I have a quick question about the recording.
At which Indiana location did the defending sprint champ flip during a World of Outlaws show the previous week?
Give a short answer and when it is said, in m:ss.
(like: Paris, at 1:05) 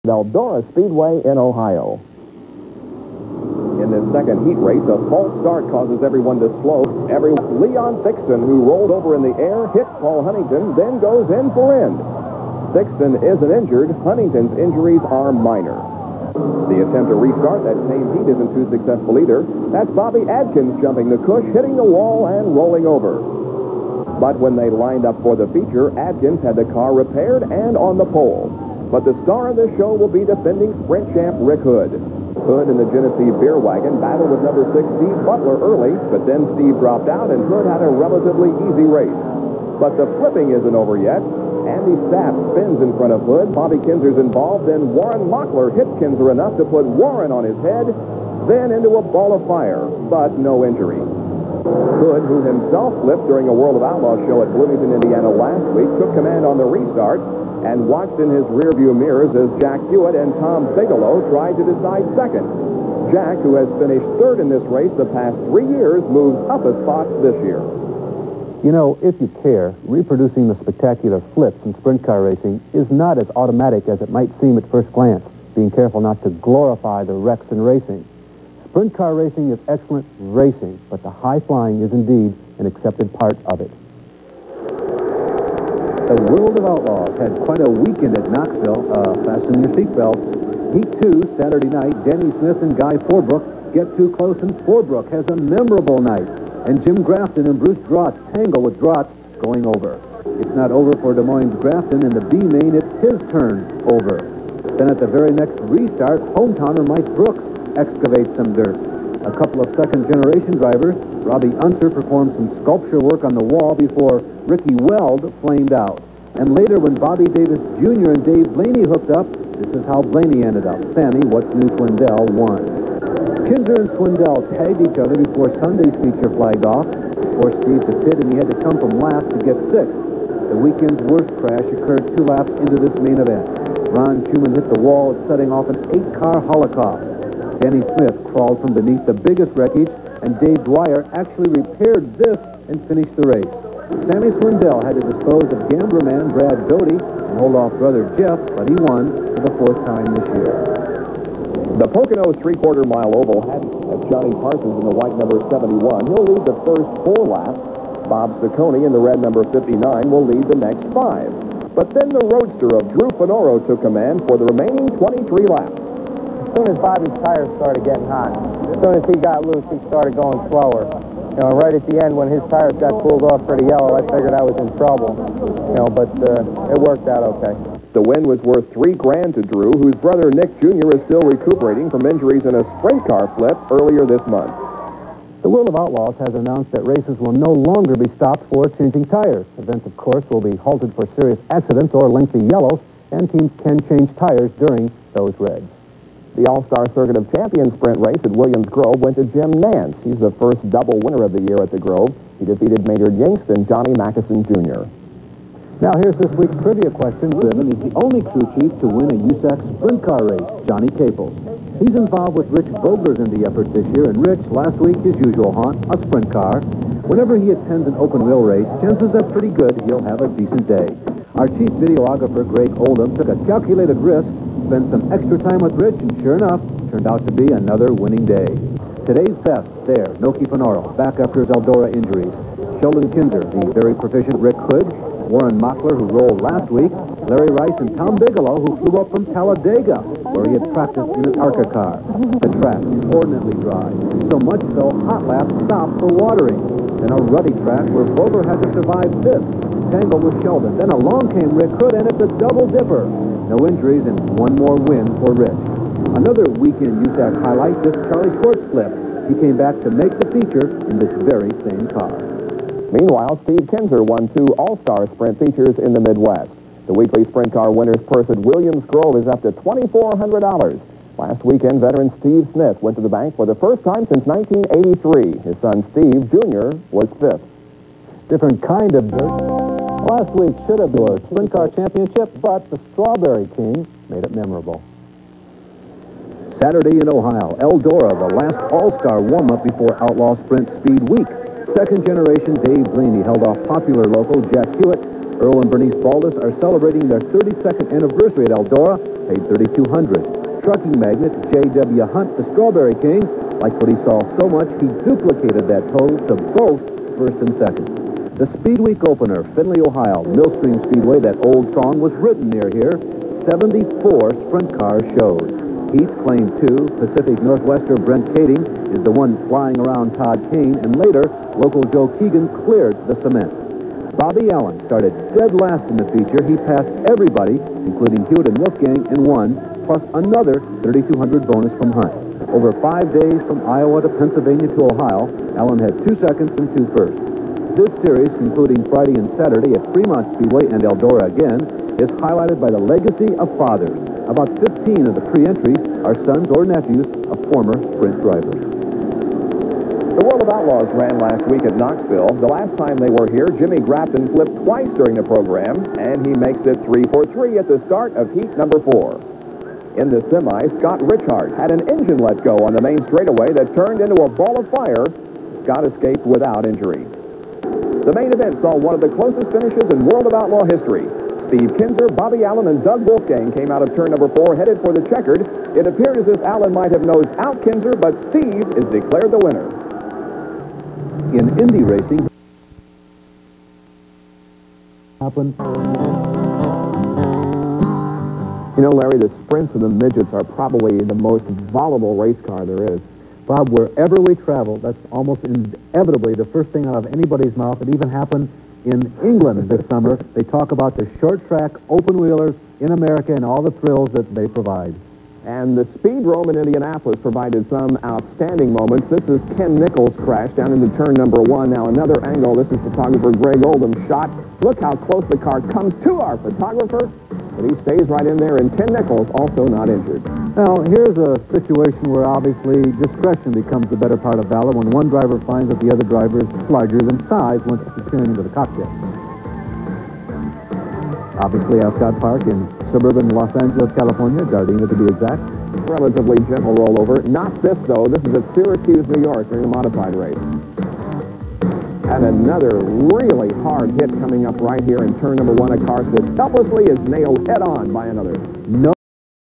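Bloomington, at 0:54.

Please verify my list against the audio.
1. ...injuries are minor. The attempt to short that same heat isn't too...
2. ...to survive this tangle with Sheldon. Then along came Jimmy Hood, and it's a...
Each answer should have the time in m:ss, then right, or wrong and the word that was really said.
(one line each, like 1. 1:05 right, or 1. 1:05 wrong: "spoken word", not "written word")
1. 0:14 wrong: "restart", not "short"
2. 4:08 wrong: "Rick", not "Jimmy".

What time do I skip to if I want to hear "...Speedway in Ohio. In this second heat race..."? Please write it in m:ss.
0:00.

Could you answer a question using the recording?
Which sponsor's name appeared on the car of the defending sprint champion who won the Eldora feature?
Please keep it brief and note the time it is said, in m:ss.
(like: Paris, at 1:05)
Genesee Beer Wagon, at 0:32.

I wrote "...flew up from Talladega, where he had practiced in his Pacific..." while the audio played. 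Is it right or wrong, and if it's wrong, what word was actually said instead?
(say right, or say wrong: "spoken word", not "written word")
wrong: "ARCA", not "Pacific".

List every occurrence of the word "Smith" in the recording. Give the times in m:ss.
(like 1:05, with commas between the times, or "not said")
1:32, 2:17, 4:32.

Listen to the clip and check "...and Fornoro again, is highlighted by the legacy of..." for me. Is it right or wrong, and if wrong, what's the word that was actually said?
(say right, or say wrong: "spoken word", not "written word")
wrong: "Eldora", not "Fornoro".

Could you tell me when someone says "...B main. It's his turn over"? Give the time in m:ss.
1:42.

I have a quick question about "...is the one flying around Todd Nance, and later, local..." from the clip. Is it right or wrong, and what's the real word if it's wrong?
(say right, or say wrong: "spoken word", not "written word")
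wrong: "Kane", not "Nance".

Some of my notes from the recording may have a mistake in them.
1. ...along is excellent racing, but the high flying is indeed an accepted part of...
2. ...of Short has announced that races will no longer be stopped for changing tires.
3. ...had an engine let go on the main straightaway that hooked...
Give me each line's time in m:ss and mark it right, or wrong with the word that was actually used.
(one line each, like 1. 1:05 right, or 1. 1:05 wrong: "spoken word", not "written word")
1. 1:19 wrong: "racing", not "along"
2. 3:05 wrong: "Outlaws", not "Short"
3. 6:01 wrong: "turned", not "hooked".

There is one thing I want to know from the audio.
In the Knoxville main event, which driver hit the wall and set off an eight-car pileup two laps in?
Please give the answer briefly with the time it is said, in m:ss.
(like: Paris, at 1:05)
Ron Shuman, at 2:13.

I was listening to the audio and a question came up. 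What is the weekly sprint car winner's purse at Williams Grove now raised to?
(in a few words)
$2,400.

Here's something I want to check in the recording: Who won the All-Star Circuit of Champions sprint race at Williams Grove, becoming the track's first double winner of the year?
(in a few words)
Jim Nance.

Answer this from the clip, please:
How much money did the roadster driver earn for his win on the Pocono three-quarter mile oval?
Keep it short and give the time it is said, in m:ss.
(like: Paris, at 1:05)
3000, at 2:58.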